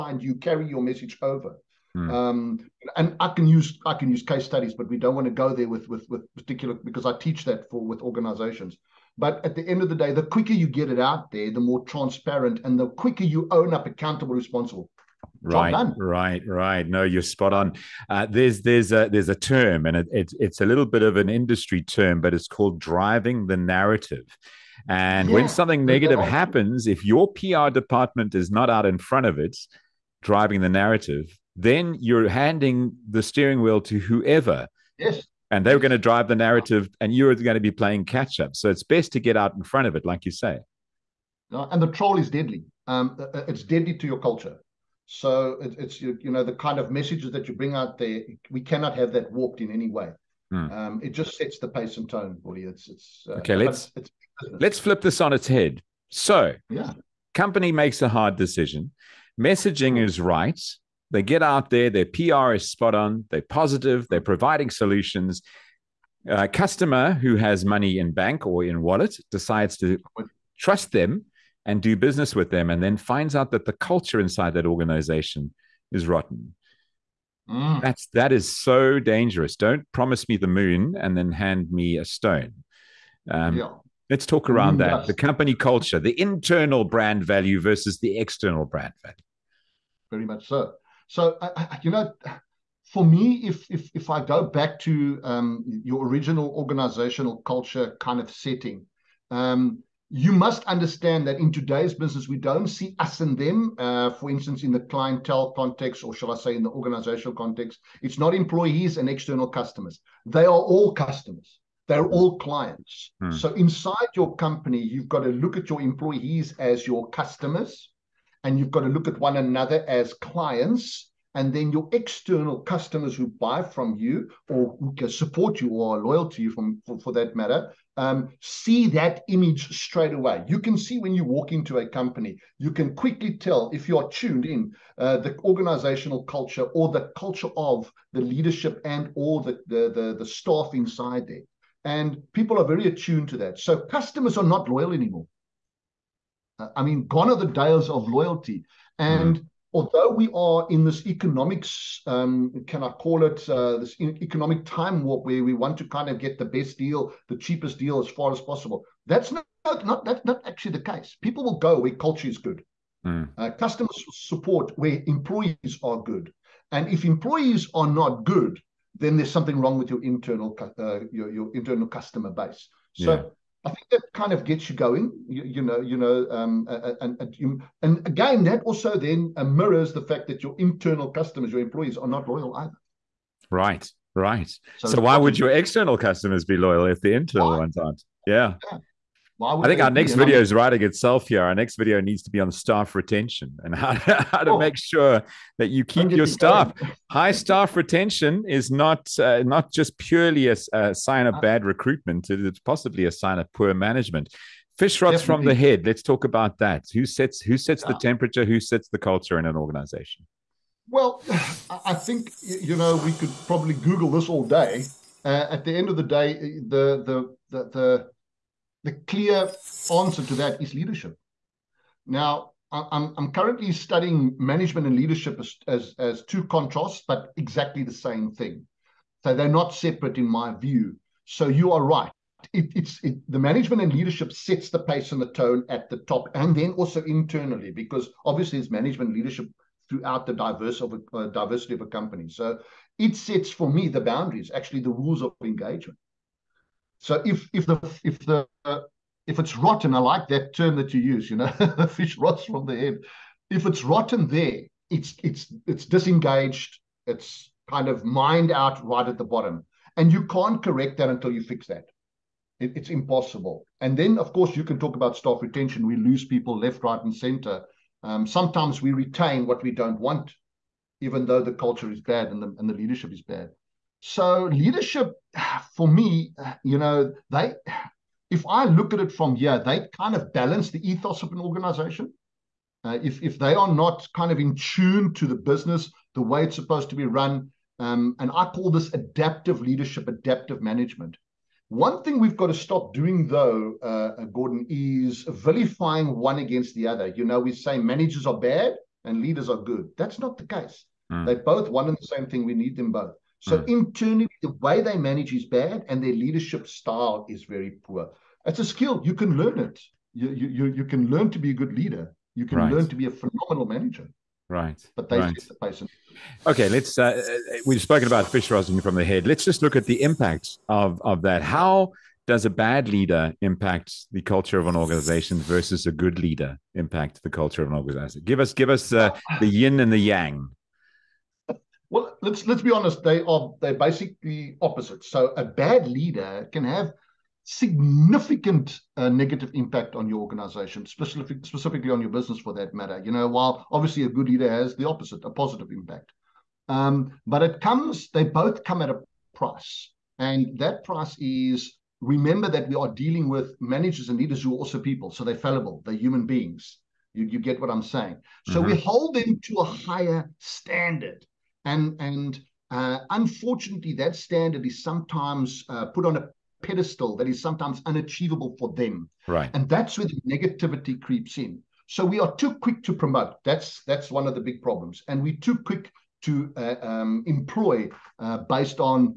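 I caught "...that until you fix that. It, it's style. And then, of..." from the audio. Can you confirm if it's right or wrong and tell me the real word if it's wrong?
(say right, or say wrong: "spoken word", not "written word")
wrong: "impossible", not "style".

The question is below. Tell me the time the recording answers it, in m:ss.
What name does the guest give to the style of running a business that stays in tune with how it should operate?
4:48.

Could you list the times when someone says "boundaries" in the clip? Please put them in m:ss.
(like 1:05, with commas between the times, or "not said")
4:04.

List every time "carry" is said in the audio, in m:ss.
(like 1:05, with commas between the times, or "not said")
0:00.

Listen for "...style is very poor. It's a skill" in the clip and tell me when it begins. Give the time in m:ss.
5:06.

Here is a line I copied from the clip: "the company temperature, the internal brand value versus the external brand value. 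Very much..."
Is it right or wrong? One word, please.
wrong.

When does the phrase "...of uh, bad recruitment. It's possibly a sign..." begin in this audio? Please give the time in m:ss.
3:21.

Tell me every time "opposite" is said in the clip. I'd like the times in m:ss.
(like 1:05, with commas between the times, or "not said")
5:34, 5:44.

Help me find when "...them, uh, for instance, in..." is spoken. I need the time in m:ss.
1:43.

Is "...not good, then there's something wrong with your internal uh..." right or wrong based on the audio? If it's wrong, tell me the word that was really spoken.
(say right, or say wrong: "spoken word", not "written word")
right.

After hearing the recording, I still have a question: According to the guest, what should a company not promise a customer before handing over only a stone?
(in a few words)
The moon.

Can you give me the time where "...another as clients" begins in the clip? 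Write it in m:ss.
1:59.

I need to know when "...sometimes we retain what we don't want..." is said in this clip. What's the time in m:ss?
4:28.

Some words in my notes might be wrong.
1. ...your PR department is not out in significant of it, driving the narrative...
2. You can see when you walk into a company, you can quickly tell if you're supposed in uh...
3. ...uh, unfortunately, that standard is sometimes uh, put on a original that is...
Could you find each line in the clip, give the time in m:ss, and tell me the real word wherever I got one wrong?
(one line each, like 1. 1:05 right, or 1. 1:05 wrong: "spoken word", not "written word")
1. 0:27 wrong: "front", not "significant"
2. 2:10 wrong: "tuned", not "supposed"
3. 6:02 wrong: "pedestal", not "original".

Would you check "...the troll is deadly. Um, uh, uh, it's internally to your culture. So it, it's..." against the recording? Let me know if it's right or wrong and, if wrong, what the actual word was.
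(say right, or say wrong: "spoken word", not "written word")
wrong: "deadly", not "internally".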